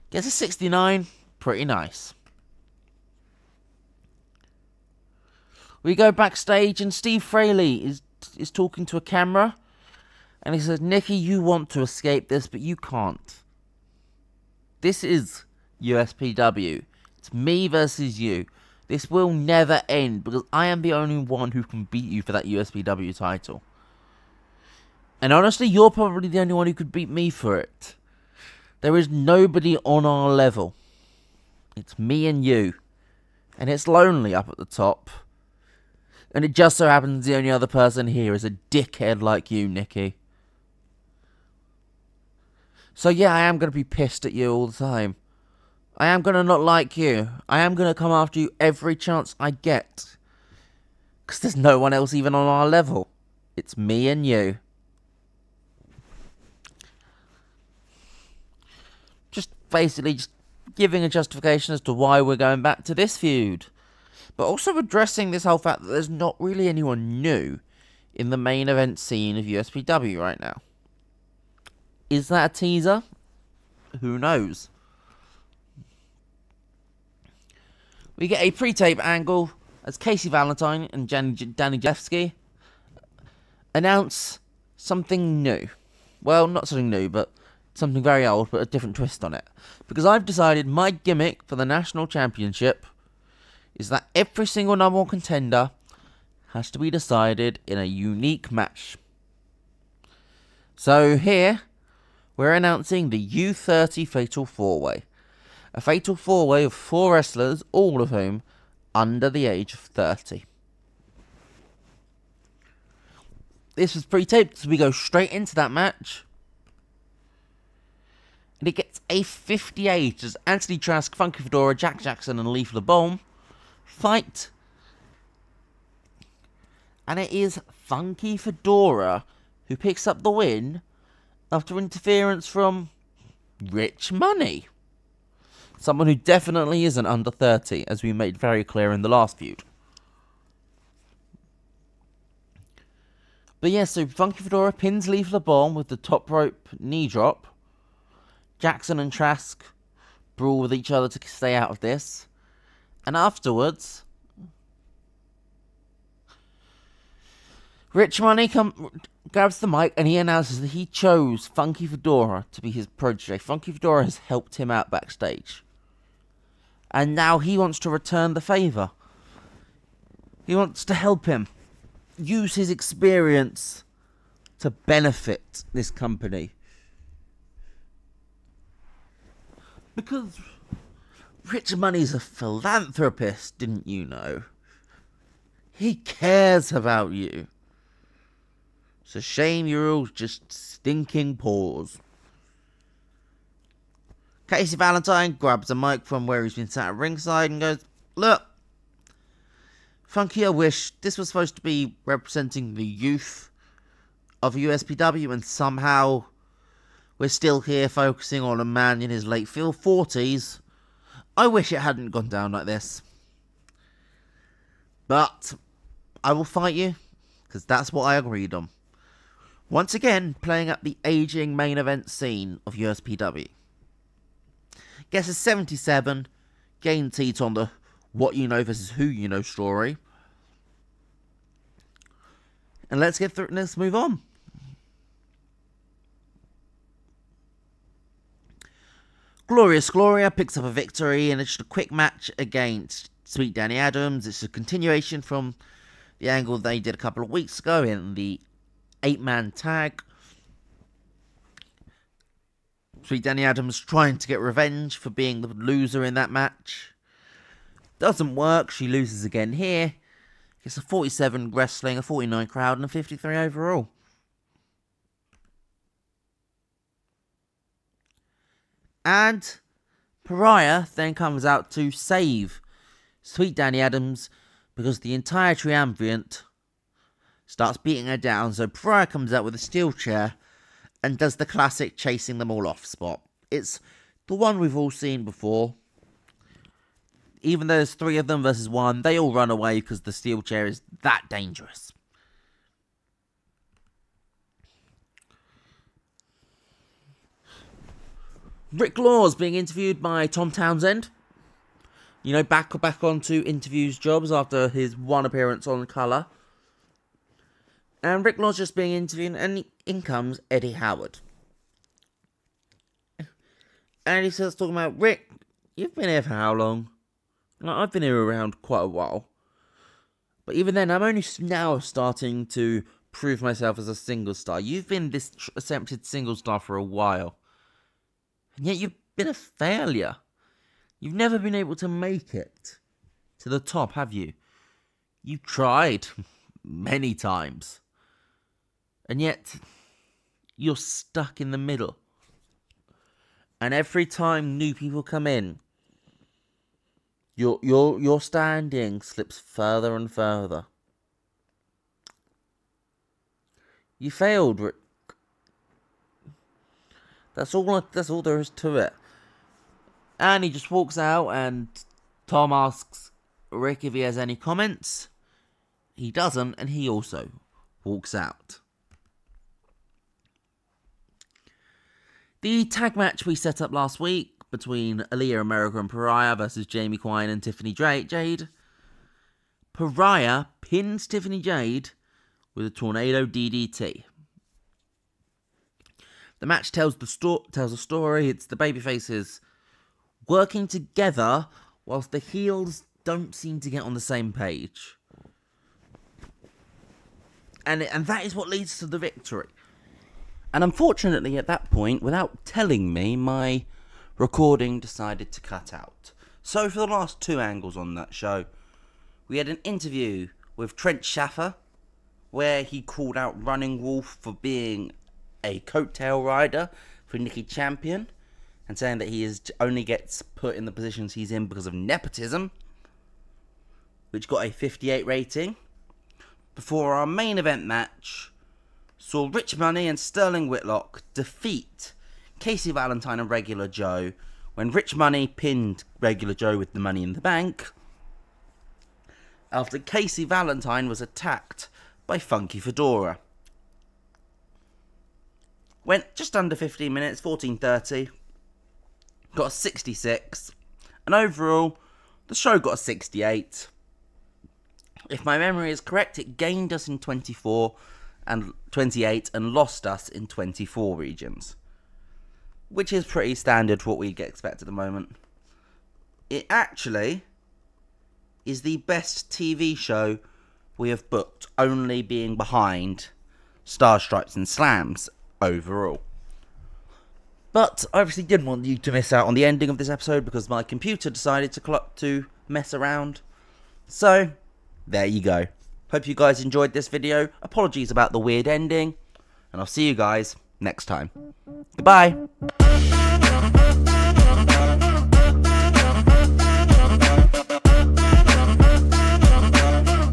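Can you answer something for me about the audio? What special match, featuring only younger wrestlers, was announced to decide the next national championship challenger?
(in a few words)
U30 Fatal 4-Way.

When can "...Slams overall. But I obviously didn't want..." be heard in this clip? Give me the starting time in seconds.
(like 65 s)
474 s.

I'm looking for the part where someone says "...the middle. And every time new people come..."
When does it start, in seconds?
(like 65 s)
341 s.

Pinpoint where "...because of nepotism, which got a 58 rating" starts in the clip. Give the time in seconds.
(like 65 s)
421 s.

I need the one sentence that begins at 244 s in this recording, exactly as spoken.
It's a continuation from the angle they did a couple of weeks ago in the eight man tag.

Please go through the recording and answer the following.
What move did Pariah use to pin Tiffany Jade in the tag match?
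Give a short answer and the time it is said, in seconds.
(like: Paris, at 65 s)
tornado DDT, at 382 s.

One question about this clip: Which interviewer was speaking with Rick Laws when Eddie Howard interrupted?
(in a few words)
Tom Townsend.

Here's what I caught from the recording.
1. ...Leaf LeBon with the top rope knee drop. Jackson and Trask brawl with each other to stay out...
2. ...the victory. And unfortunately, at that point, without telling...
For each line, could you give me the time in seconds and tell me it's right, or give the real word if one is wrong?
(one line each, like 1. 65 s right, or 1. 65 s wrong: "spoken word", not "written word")
1. 145 s right
2. 398 s right.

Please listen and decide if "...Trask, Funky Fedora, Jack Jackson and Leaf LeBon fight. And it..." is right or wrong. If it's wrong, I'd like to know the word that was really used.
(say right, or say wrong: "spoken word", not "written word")
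right.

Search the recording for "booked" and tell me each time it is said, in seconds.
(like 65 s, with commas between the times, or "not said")
471 s.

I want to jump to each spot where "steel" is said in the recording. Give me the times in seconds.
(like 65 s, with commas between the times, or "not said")
279 s, 290 s.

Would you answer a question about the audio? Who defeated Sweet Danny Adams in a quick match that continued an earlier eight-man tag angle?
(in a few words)
Glorious Gloria.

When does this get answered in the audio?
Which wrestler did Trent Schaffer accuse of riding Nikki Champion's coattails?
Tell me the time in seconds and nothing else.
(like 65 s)
413 s.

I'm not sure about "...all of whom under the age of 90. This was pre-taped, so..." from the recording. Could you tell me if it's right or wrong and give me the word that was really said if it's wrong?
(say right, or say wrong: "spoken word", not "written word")
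wrong: "30", not "90".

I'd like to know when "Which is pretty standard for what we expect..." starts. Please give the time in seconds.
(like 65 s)
462 s.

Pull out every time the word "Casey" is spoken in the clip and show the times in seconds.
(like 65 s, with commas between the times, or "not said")
79 s, 194 s, 432 s, 439 s.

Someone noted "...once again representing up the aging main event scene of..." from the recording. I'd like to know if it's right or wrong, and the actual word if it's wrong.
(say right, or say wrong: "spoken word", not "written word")
wrong: "playing", not "representing".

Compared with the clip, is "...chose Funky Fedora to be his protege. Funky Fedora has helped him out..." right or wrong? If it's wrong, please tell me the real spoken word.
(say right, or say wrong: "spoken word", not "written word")
right.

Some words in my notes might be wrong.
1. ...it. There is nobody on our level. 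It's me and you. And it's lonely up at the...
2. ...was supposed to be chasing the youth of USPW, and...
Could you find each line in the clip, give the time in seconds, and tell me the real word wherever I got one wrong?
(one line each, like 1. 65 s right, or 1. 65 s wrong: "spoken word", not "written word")
1. 27 s right
2. 201 s wrong: "representing", not "chasing".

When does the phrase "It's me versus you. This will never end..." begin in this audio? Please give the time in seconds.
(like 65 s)
17 s.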